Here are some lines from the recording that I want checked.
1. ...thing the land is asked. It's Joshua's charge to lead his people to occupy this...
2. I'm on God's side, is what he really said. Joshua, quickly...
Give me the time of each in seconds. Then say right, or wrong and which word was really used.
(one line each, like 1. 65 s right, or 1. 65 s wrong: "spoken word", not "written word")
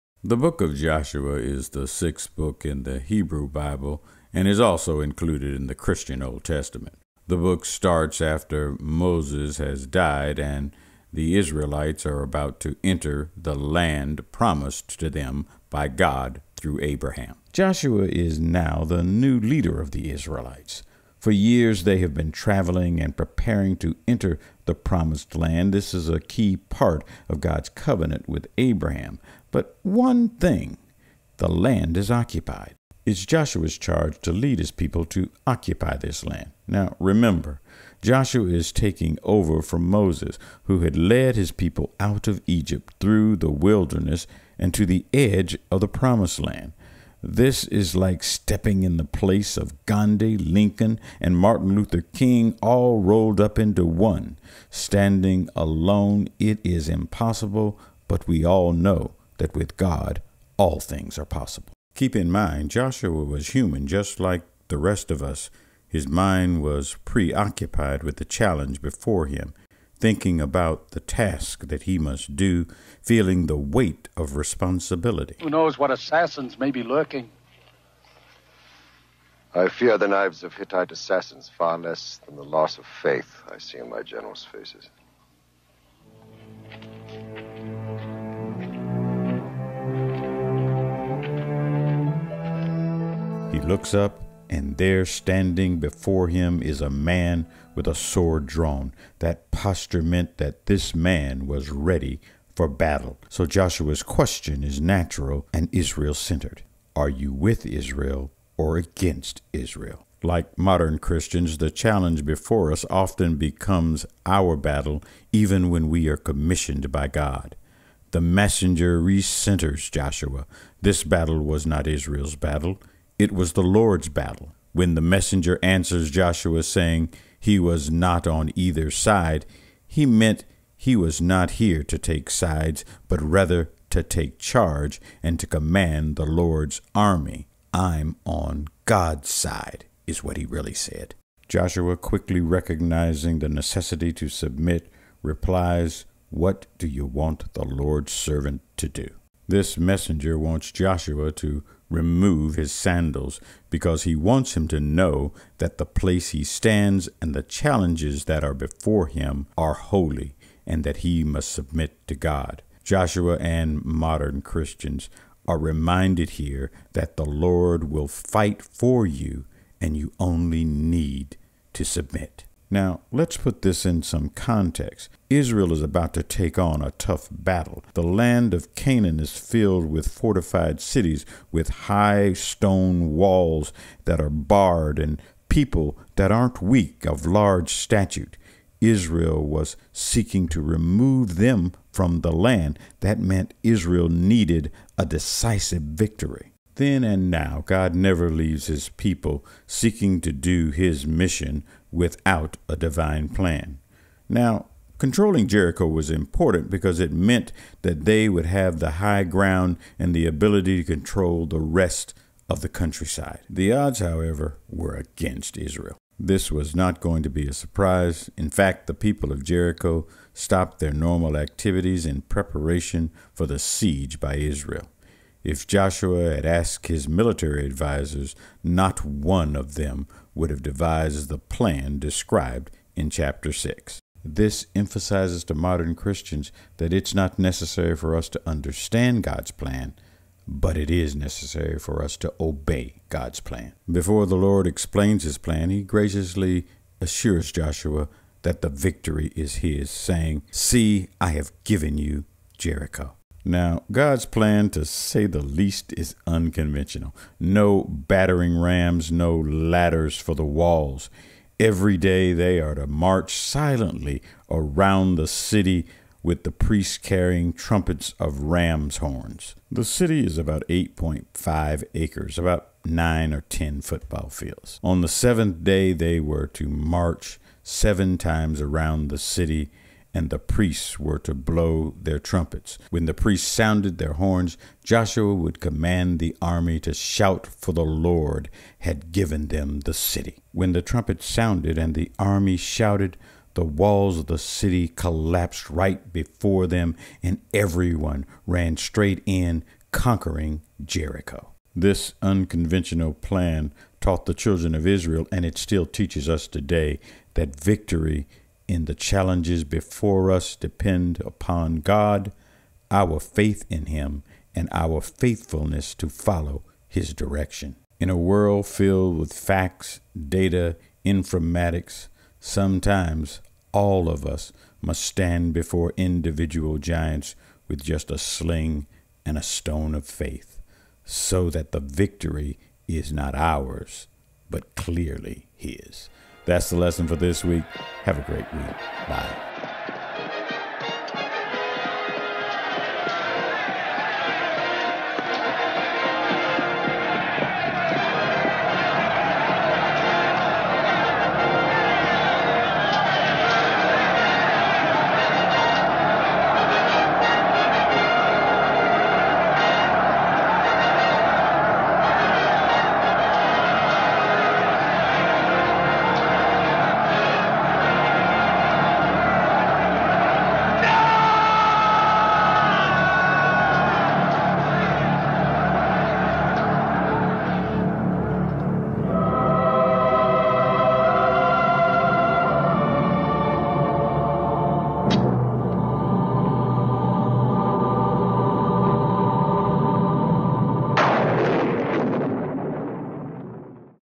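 1. 30 s wrong: "occupied", not "asked"
2. 137 s right.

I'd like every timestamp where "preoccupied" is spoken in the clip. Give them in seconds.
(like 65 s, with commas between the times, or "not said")
67 s.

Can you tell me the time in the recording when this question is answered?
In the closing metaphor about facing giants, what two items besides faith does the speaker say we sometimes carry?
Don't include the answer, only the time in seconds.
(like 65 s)
328 s.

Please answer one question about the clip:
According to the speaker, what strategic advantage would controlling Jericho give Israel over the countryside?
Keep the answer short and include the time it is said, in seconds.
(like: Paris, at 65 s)
the high ground, at 208 s.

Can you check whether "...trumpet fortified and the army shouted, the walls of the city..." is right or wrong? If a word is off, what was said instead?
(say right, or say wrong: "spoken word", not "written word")
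wrong: "sounded", not "fortified".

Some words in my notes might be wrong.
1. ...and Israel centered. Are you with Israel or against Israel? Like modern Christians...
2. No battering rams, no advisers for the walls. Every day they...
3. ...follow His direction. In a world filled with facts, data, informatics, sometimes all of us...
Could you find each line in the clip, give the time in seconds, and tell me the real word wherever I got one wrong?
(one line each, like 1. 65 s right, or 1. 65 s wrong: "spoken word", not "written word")
1. 105 s right
2. 257 s wrong: "ladders", not "advisers"
3. 316 s right.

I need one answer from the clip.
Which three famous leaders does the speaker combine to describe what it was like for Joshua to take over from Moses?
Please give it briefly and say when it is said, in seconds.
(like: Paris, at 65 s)
Gandhi, Lincoln, and Martin Luther King, at 49 s.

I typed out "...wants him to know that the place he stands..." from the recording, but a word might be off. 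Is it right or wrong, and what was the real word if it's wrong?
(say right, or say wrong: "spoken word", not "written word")
right.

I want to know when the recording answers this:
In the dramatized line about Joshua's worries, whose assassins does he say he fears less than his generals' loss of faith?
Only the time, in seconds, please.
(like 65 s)
80 s.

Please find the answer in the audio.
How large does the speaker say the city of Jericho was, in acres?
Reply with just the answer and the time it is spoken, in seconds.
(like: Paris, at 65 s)
8.5 acres, at 270 s.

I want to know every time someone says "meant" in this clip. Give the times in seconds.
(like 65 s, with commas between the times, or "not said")
100 s, 130 s, 193 s, 207 s.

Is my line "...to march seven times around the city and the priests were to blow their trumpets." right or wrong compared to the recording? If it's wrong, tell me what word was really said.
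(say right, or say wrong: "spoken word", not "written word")
right.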